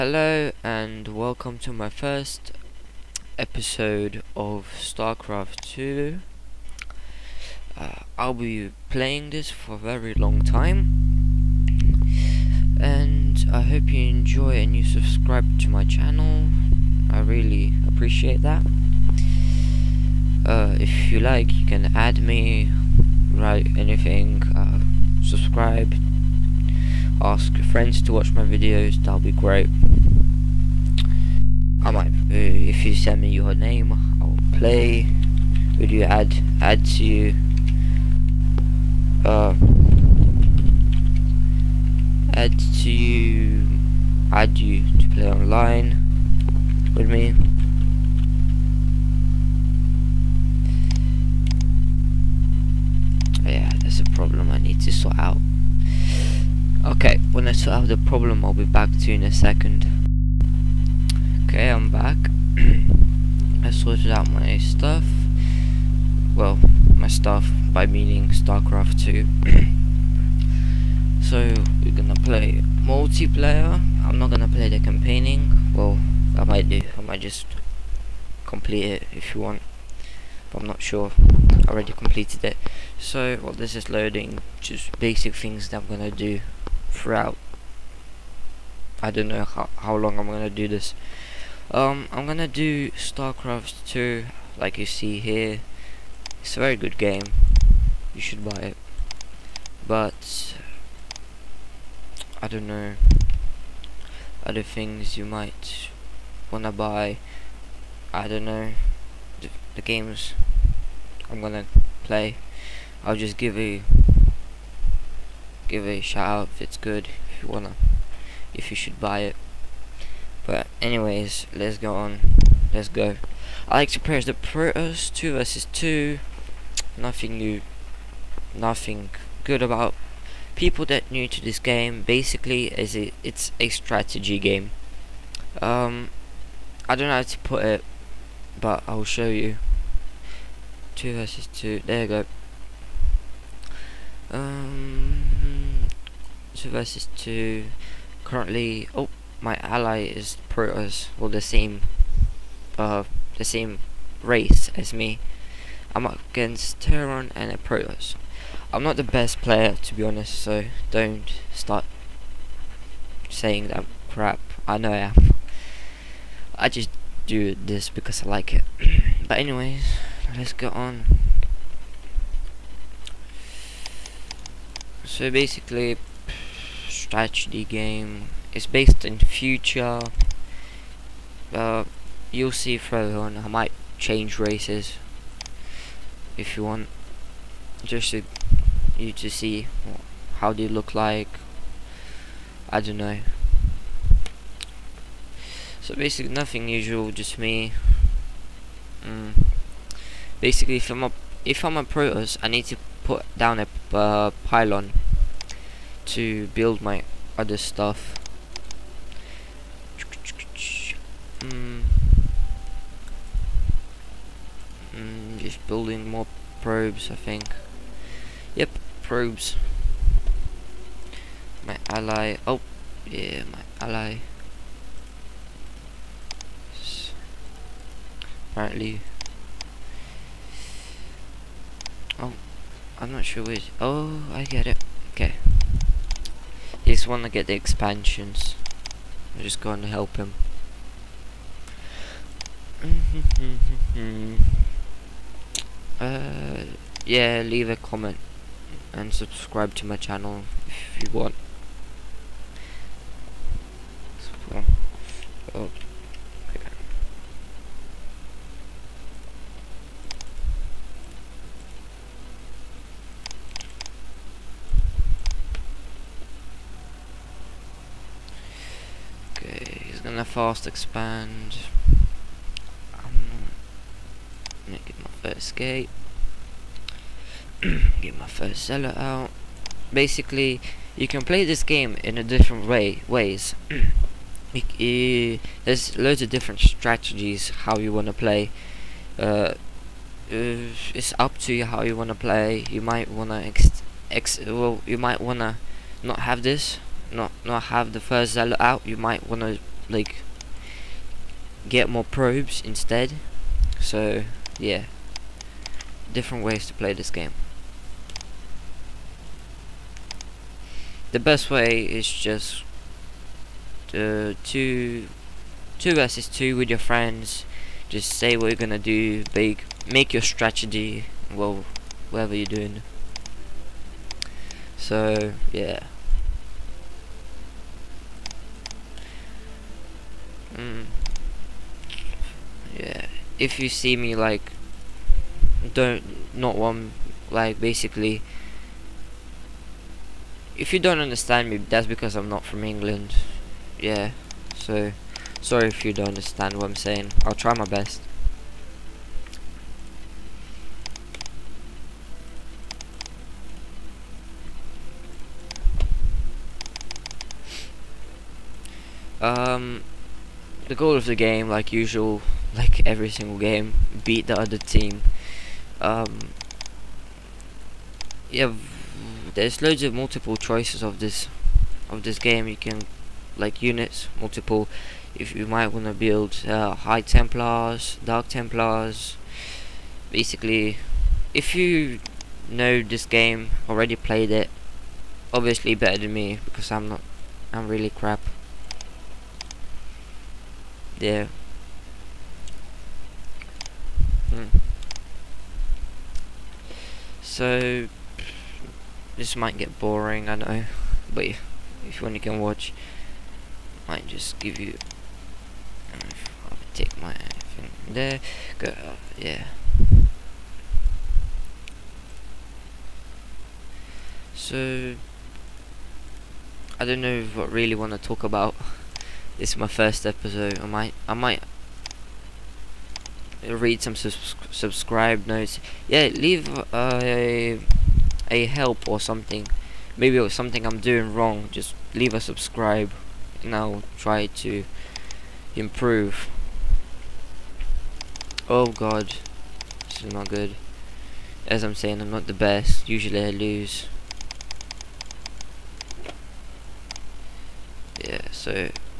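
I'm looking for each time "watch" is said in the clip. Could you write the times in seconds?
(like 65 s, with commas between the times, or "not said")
28 s, 402 s.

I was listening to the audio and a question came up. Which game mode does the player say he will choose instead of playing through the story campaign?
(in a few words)
Multiplayer.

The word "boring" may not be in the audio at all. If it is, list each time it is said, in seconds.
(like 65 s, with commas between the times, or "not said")
399 s.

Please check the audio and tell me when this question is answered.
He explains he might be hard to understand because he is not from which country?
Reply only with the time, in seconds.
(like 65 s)
342 s.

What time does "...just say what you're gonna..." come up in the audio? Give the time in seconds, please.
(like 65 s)
317 s.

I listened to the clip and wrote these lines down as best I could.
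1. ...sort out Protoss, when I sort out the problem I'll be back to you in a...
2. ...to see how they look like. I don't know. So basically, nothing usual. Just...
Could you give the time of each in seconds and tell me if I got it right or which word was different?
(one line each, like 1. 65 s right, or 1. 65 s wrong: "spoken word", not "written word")
1. 54 s wrong: "Okay", not "Protoss"
2. 189 s right.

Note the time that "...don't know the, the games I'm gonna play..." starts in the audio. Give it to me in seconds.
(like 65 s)
108 s.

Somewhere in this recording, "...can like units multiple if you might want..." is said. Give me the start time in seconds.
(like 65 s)
372 s.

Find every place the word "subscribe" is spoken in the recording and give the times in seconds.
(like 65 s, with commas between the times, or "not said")
14 s, 25 s, 249 s, 423 s, 432 s.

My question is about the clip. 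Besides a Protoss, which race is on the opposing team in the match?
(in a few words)
Terran.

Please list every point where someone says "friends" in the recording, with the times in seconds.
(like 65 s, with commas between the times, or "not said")
27 s, 316 s.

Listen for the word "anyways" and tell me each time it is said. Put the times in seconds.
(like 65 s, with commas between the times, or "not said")
120 s, 169 s.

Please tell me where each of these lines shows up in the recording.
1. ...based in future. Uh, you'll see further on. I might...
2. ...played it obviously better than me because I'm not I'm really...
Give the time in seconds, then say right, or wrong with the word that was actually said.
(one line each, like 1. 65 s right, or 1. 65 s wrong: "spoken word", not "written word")
1. 178 s right
2. 383 s right.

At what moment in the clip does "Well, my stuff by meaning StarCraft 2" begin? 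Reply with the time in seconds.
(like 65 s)
66 s.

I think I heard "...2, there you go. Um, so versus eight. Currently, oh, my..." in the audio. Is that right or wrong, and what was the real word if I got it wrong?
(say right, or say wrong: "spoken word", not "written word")
wrong: "two", not "eight".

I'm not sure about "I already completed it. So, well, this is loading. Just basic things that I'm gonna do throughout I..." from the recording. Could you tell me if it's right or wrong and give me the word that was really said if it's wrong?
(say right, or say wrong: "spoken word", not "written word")
right.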